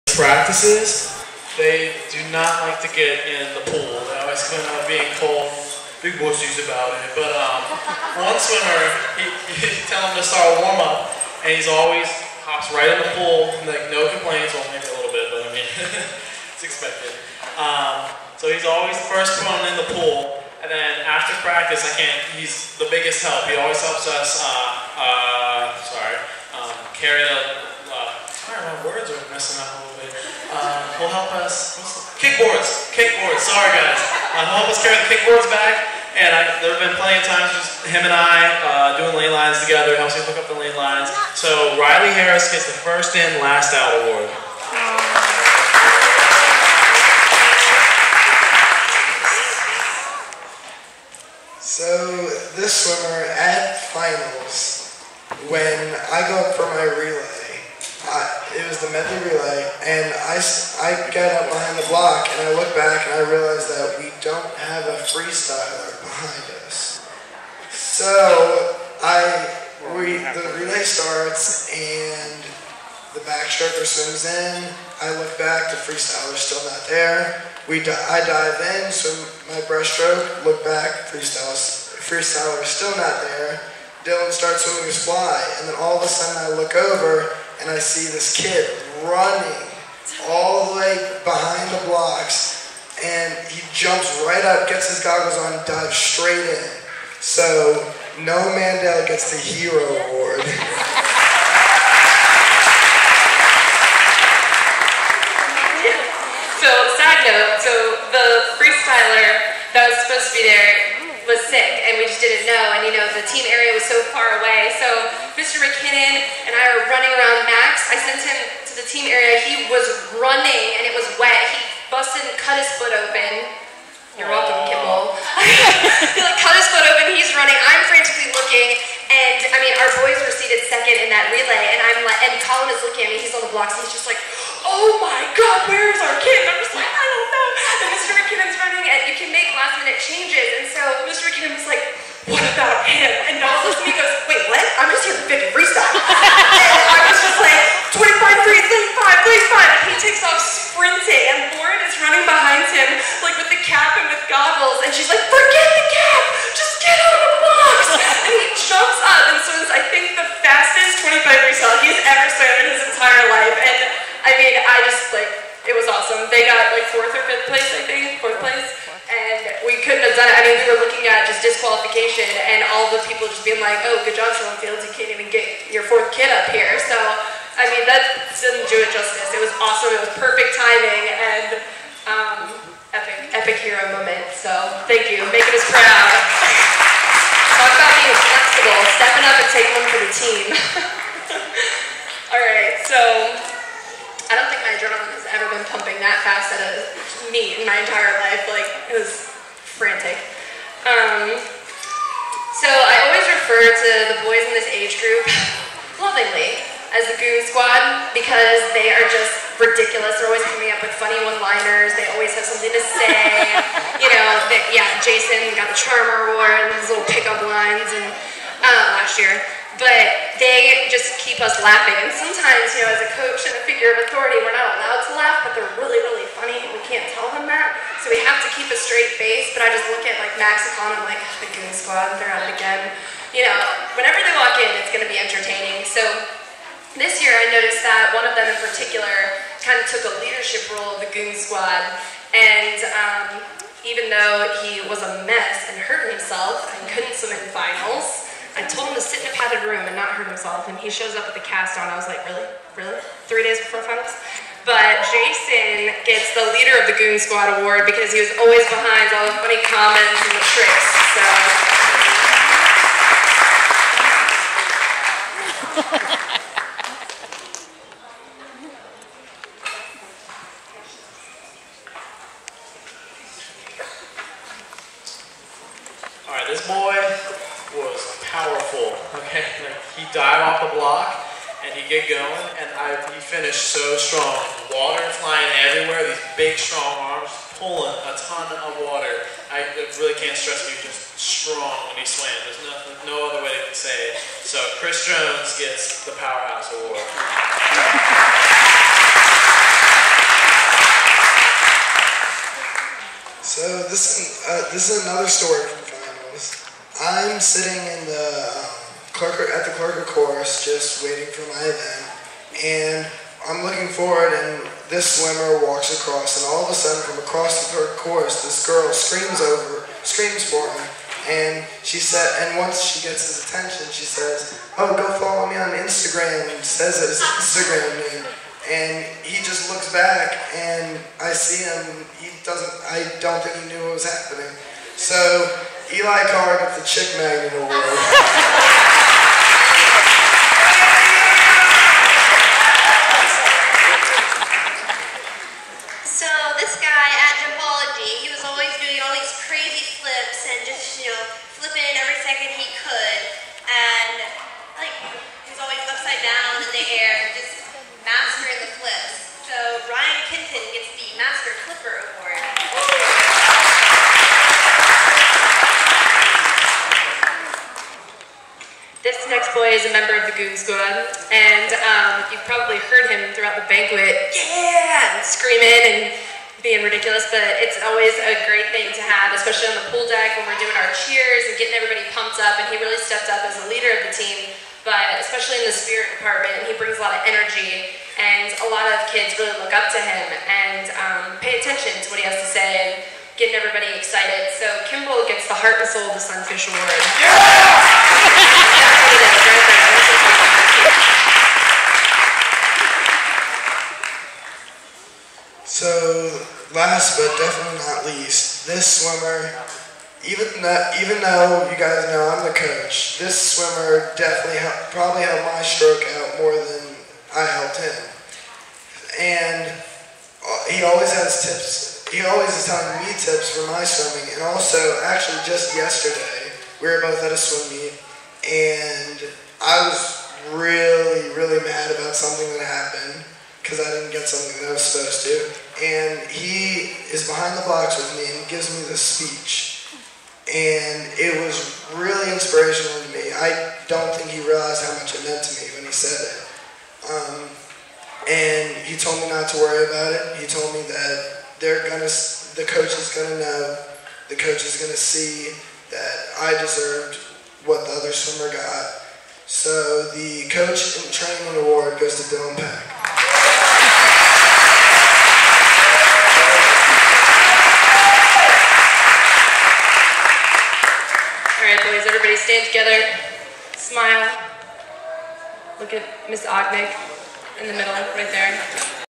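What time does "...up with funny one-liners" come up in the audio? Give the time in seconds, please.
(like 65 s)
210 s.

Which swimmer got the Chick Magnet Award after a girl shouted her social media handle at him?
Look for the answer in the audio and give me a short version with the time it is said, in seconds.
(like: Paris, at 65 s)
Eli Carr, at 335 s.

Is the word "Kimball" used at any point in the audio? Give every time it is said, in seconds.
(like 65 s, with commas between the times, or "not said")
124 s, 394 s.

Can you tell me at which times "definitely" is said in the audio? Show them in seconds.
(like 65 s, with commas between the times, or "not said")
407 s, 414 s.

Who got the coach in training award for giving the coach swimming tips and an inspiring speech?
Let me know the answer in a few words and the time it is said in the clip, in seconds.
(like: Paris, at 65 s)
Dylan Pack, at 462 s.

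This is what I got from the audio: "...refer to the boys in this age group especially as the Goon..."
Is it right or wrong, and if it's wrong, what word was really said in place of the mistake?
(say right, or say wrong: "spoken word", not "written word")
wrong: "lovingly", not "especially".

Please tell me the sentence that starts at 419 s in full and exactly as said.
And uh, he always has tips.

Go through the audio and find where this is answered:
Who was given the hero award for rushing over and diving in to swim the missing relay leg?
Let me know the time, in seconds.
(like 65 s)
98 s.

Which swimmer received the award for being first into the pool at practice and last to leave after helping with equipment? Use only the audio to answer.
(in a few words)
Riley Harris.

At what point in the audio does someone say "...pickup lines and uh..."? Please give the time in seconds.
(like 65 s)
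217 s.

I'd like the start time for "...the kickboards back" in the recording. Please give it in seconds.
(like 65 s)
35 s.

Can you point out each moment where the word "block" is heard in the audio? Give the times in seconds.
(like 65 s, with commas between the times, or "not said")
61 s, 133 s, 280 s.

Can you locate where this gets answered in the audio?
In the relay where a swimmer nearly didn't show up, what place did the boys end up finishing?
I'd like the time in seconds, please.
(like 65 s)
168 s.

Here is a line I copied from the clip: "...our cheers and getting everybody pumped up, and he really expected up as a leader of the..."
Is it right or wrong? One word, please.
wrong.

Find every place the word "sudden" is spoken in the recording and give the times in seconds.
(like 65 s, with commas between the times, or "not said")
86 s, 316 s.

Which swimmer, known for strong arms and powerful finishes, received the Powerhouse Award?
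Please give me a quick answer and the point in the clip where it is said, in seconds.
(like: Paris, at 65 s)
Chris Jones, at 294 s.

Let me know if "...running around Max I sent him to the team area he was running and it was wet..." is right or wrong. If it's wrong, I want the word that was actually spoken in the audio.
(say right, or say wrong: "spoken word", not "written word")
right.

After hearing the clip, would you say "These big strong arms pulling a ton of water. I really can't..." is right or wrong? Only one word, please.
right.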